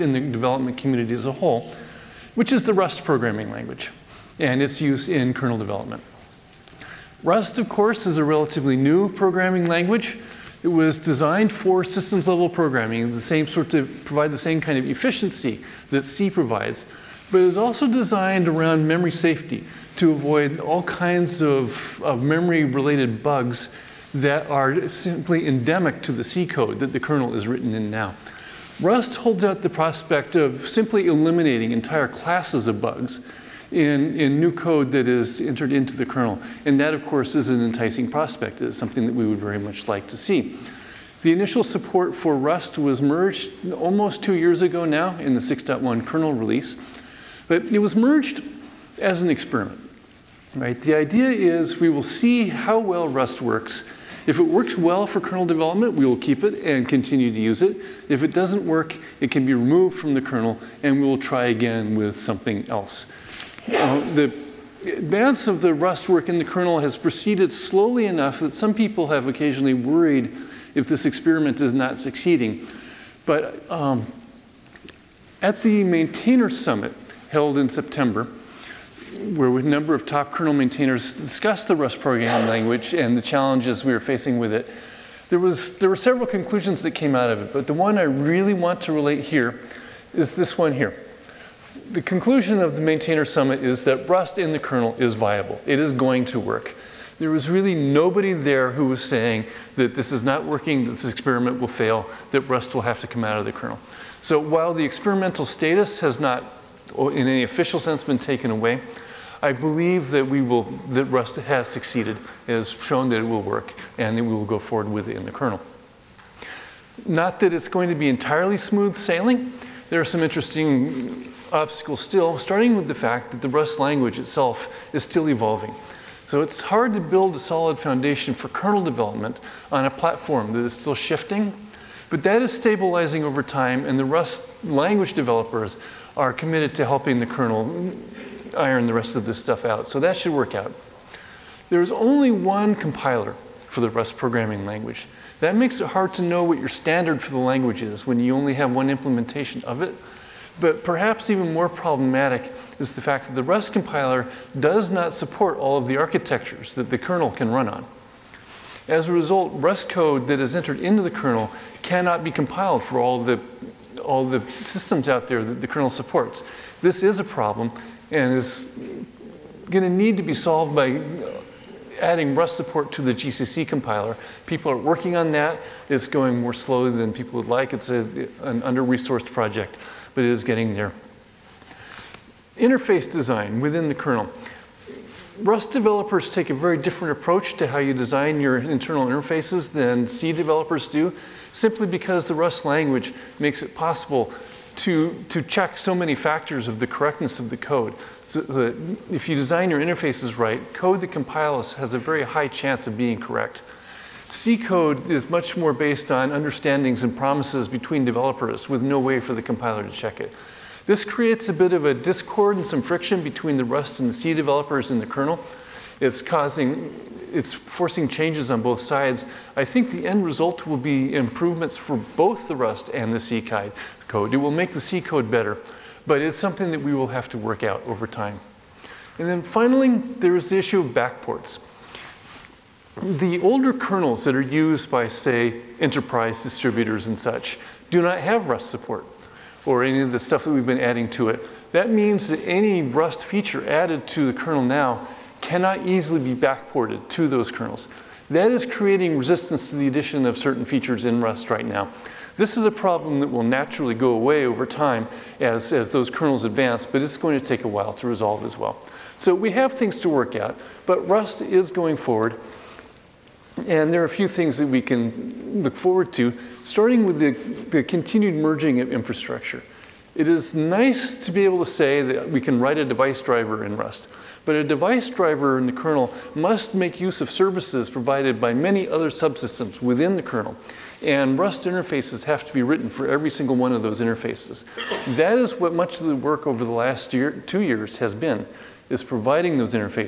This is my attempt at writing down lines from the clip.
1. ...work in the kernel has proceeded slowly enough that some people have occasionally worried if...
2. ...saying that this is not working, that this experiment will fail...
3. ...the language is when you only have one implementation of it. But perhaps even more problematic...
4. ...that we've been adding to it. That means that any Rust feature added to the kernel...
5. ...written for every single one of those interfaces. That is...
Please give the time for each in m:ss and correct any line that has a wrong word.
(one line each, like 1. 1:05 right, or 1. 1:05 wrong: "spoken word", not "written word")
1. 1:06 right
2. 1:39 right
3. 2:27 right
4. 4:00 right
5. 4:42 right.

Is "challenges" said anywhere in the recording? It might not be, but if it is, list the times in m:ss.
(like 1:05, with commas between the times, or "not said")
1:23.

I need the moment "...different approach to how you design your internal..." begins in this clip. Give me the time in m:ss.
3:06.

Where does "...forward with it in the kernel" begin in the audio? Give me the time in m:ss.
1:54.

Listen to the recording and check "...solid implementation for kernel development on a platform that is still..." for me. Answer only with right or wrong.
wrong.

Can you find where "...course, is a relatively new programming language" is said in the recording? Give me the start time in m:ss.
0:07.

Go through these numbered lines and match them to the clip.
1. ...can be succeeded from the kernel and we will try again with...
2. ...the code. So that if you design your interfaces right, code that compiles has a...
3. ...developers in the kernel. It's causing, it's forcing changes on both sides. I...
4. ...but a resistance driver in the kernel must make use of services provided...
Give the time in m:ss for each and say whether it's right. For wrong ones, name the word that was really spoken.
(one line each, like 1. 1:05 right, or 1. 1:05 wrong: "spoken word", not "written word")
1. 0:59 wrong: "removed", not "succeeded"
2. 3:17 right
3. 3:34 right
4. 4:34 wrong: "device", not "resistance".